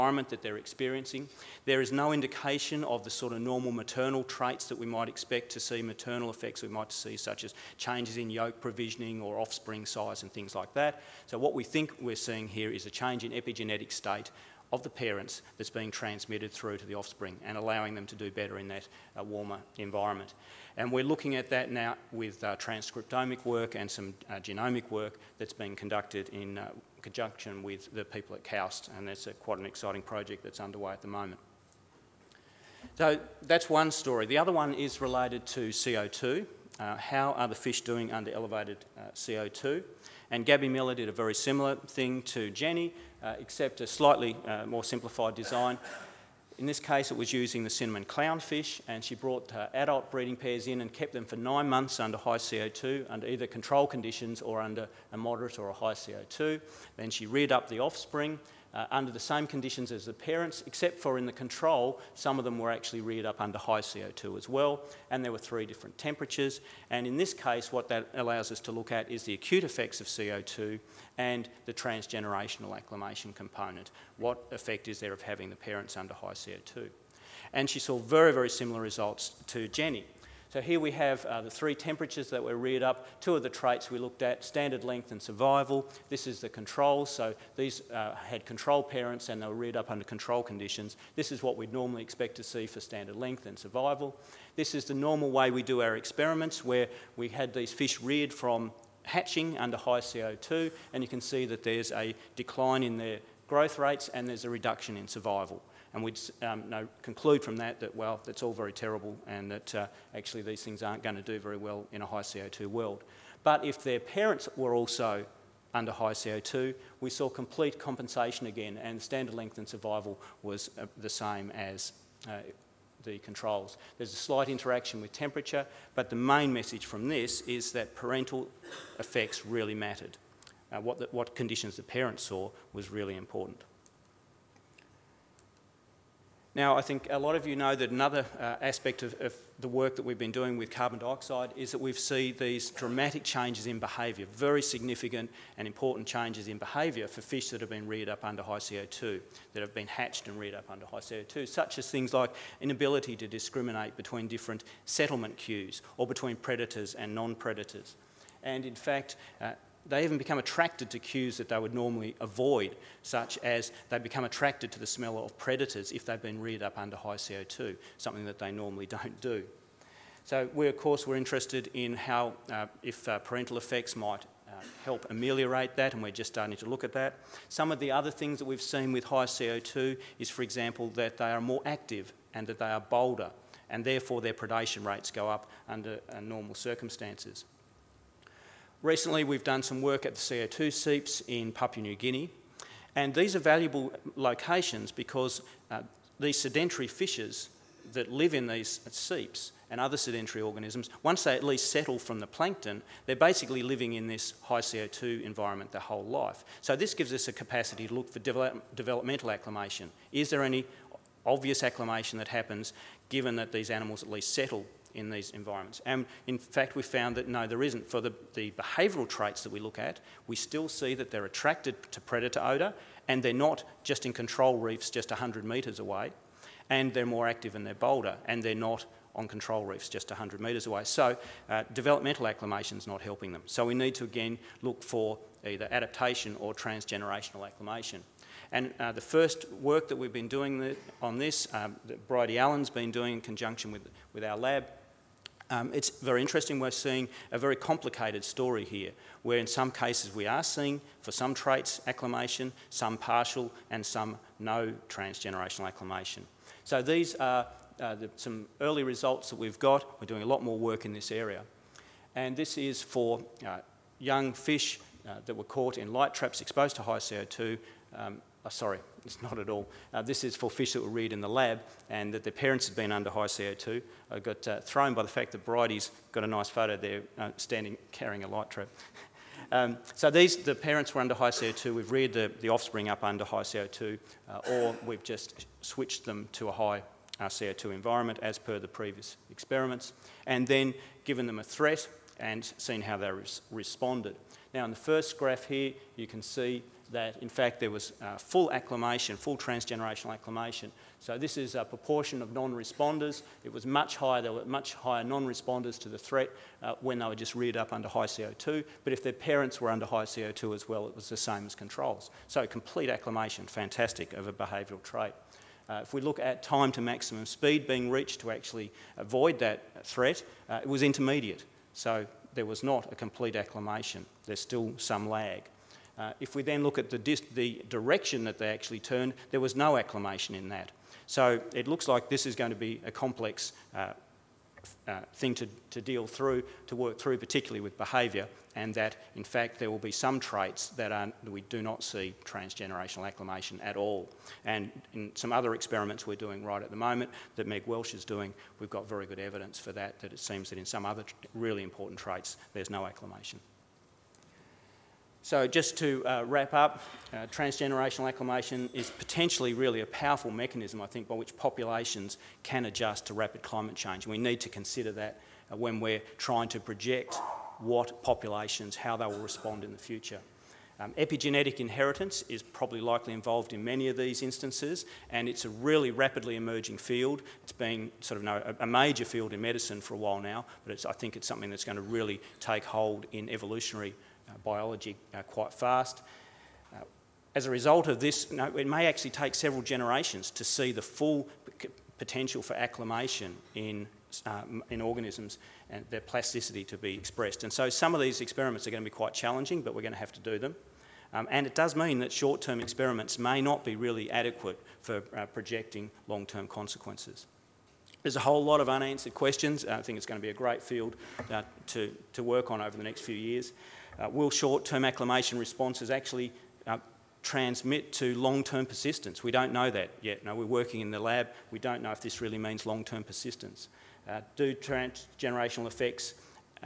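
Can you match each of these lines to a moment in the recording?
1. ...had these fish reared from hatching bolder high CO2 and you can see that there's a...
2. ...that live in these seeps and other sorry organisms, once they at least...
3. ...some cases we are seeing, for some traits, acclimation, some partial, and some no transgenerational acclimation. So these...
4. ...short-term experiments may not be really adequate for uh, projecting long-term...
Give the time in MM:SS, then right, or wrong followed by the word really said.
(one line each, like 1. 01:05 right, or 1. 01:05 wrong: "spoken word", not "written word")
1. 01:37 wrong: "under", not "bolder"
2. 03:17 wrong: "sedentary", not "sorry"
3. 04:09 right
4. 06:42 right.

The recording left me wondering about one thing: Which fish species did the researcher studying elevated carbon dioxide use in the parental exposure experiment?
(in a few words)
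cinnamon clownfish.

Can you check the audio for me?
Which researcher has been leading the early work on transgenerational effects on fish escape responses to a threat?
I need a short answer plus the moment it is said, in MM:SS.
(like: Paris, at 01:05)
Bridie Allan, at 04:02.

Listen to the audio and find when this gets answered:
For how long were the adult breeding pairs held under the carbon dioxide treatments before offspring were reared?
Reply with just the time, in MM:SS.
00:51.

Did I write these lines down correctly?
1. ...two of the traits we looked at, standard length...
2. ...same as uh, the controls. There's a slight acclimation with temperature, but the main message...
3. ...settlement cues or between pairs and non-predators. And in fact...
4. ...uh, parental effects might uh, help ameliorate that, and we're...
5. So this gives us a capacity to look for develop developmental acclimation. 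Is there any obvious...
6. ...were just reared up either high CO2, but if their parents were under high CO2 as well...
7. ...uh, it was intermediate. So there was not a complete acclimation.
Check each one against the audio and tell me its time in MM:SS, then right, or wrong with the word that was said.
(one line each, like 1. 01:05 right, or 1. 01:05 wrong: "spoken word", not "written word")
1. 01:23 right
2. 02:01 wrong: "interaction", not "acclimation"
3. 02:34 wrong: "predators", not "pairs"
4. 02:53 right
5. 03:26 right
6. 05:07 wrong: "under", not "either"
7. 05:20 right.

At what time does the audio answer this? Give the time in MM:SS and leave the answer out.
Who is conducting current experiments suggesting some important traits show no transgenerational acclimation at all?
05:47.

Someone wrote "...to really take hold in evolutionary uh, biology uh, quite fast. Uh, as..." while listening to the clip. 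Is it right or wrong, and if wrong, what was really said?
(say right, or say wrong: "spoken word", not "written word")
right.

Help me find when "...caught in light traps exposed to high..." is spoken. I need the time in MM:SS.
04:25.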